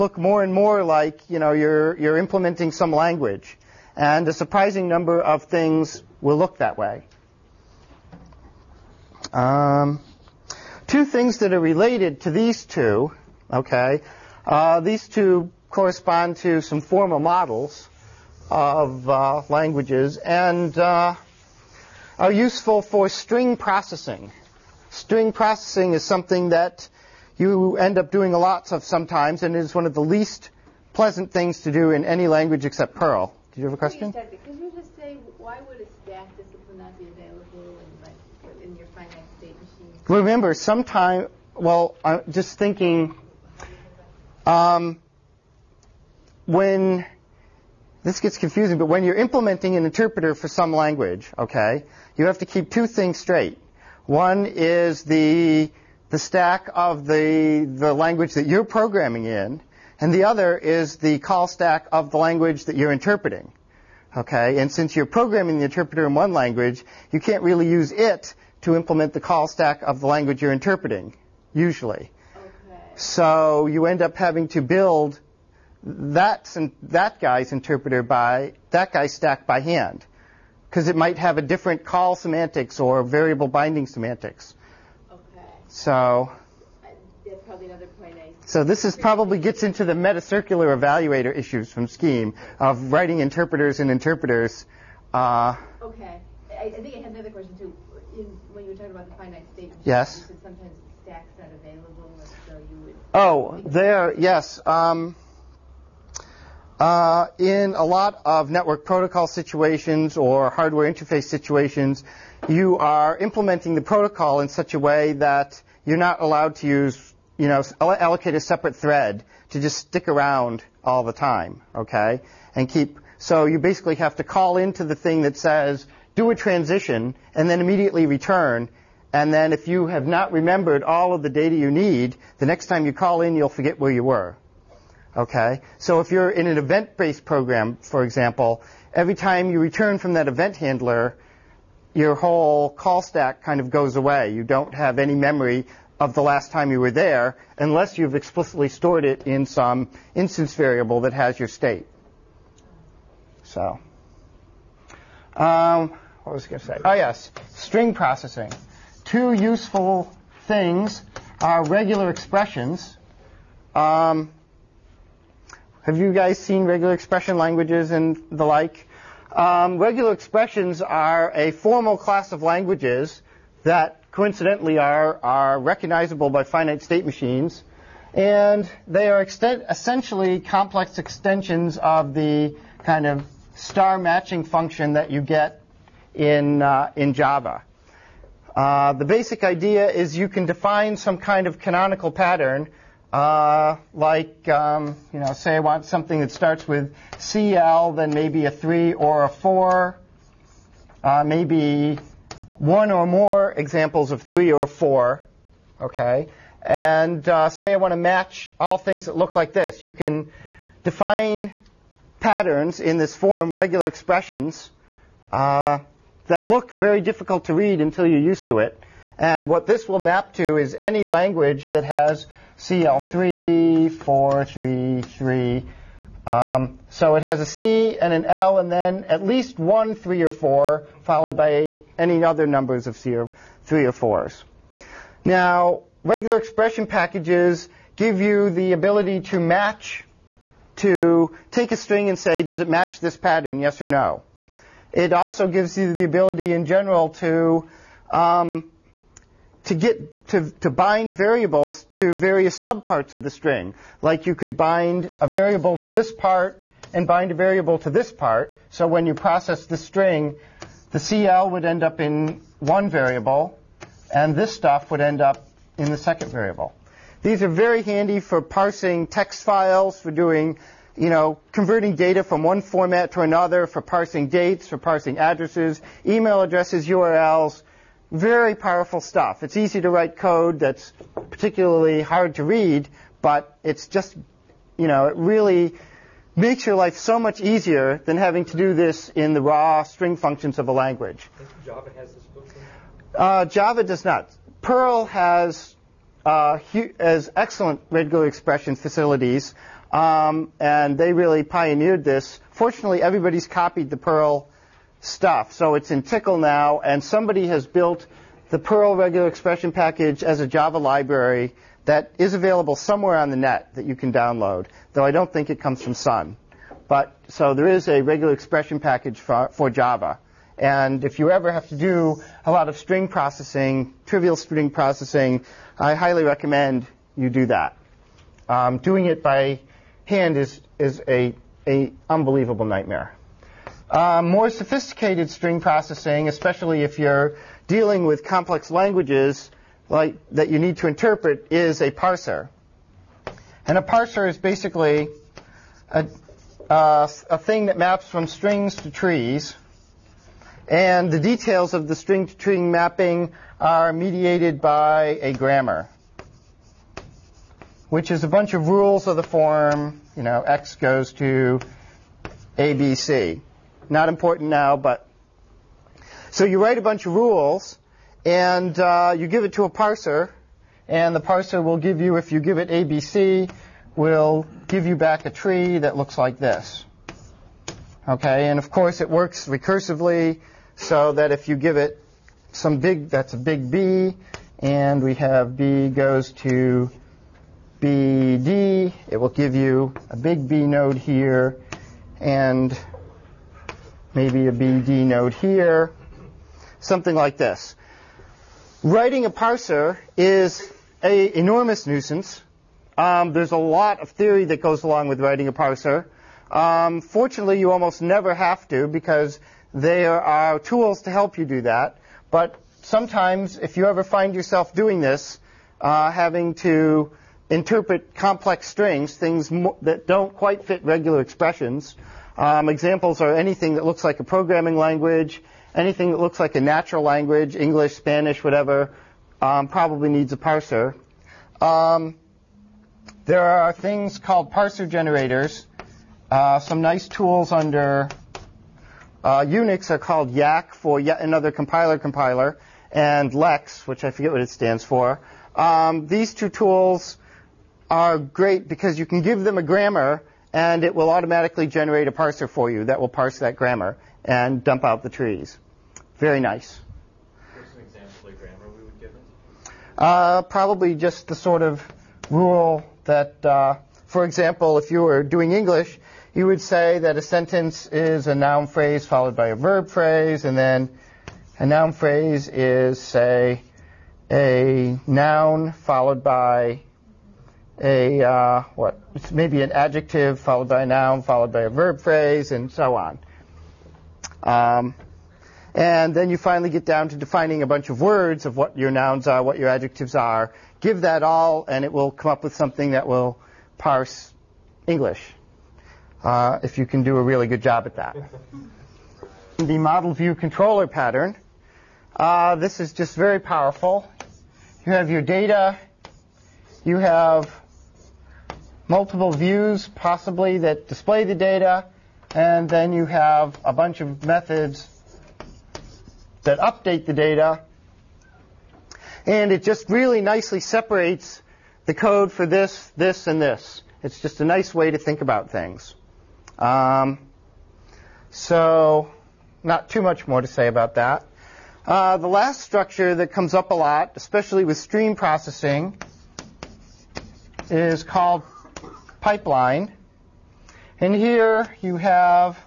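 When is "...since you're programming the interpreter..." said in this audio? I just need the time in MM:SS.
01:04.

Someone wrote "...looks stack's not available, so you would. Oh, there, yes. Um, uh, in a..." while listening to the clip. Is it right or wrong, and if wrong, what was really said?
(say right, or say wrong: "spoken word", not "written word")
wrong: "stacks", not "looks".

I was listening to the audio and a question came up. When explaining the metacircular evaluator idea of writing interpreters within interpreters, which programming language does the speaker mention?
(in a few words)
Scheme.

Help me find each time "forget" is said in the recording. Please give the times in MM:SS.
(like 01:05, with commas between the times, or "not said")
02:13, 07:24.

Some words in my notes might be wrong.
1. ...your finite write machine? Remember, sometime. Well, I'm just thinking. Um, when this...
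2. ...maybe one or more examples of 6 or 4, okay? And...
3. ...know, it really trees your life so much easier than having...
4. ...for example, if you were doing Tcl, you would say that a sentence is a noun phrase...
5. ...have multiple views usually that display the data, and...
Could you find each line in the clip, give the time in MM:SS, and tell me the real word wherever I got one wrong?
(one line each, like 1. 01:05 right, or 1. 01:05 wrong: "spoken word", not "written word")
1. 00:38 wrong: "state", not "write"
2. 03:21 wrong: "3", not "6"
3. 04:44 wrong: "makes", not "trees"
4. 07:44 wrong: "English", not "Tcl"
5. 08:26 wrong: "possibly", not "usually".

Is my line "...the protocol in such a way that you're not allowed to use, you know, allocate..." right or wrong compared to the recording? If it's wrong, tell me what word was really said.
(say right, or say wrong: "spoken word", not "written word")
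right.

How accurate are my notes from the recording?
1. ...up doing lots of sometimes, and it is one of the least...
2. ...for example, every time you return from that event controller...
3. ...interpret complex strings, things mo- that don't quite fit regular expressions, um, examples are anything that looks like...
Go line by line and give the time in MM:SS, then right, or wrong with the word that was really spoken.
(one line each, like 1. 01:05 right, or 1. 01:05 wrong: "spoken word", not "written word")
1. 00:27 right
2. 02:17 wrong: "handler", not "controller"
3. 06:57 right.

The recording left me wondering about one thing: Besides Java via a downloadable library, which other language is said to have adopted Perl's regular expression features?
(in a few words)
Tcl.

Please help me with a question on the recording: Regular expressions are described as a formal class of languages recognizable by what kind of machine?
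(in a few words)
Finite state machines.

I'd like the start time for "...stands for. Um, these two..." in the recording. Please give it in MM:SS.
07:24.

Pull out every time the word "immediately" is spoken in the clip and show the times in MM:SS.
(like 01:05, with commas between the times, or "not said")
02:07.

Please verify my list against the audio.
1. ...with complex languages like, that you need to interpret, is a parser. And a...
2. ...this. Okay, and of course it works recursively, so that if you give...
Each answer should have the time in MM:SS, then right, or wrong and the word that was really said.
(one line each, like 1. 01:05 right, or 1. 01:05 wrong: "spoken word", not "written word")
1. 05:38 right
2. 06:16 right.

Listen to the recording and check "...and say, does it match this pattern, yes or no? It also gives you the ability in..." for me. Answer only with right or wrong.
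right.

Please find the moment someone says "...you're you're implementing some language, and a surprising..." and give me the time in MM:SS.
00:01.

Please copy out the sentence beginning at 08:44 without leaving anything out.
It's just a nice way to think about things.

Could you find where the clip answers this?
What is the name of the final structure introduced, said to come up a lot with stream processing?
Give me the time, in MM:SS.
08:59.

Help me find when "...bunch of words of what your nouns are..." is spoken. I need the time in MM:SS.
08:07.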